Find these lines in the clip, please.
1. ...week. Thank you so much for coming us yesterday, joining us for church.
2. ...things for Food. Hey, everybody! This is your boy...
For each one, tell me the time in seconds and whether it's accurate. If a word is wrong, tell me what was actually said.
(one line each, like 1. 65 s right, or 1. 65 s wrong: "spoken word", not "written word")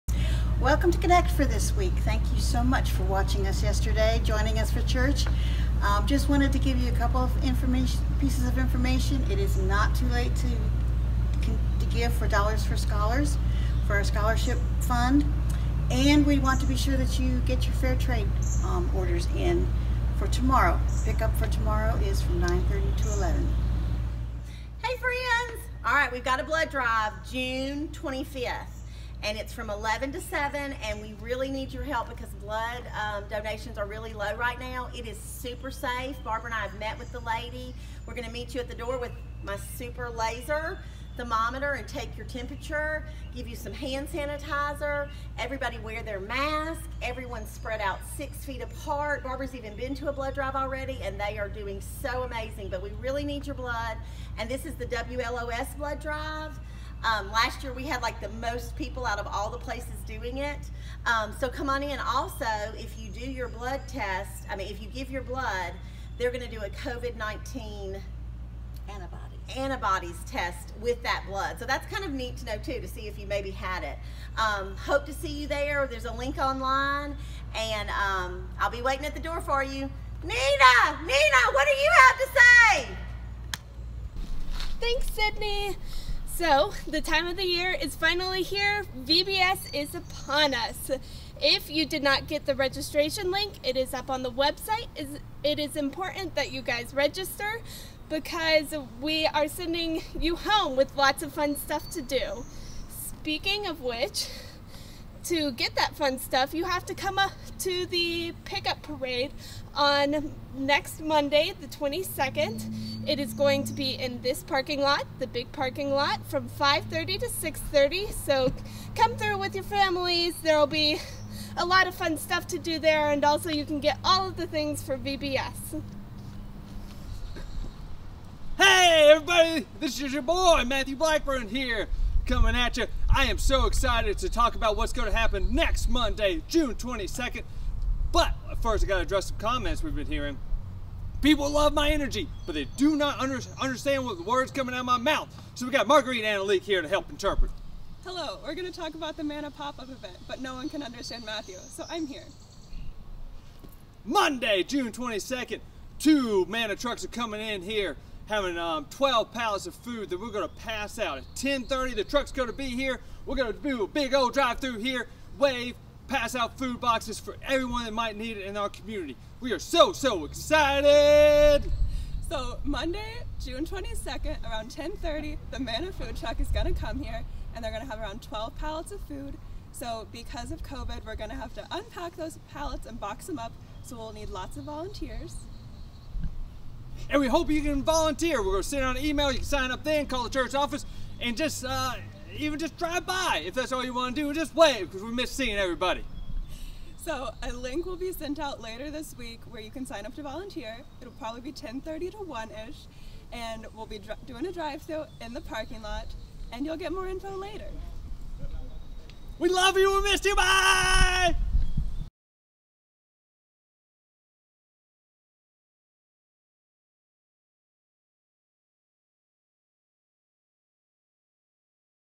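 1. 1 s wrong: "watching", not "coming"
2. 124 s wrong: "VBS", not "Food".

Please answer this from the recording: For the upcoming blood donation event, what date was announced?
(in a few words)
June 25th.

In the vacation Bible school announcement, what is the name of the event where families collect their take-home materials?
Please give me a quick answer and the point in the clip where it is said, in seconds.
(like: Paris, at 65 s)
pickup parade, at 108 s.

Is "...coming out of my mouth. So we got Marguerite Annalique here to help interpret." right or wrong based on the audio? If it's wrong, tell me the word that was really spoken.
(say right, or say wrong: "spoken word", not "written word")
right.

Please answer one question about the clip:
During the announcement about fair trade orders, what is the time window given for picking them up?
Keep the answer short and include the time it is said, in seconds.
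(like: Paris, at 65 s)
9:30 to 11, at 22 s.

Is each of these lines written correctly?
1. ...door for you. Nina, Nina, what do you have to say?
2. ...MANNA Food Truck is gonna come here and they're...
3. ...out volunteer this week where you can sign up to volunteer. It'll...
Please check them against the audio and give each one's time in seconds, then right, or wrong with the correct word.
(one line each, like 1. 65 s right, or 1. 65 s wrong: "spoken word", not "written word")
1. 79 s right
2. 175 s right
3. 198 s wrong: "later", not "volunteer".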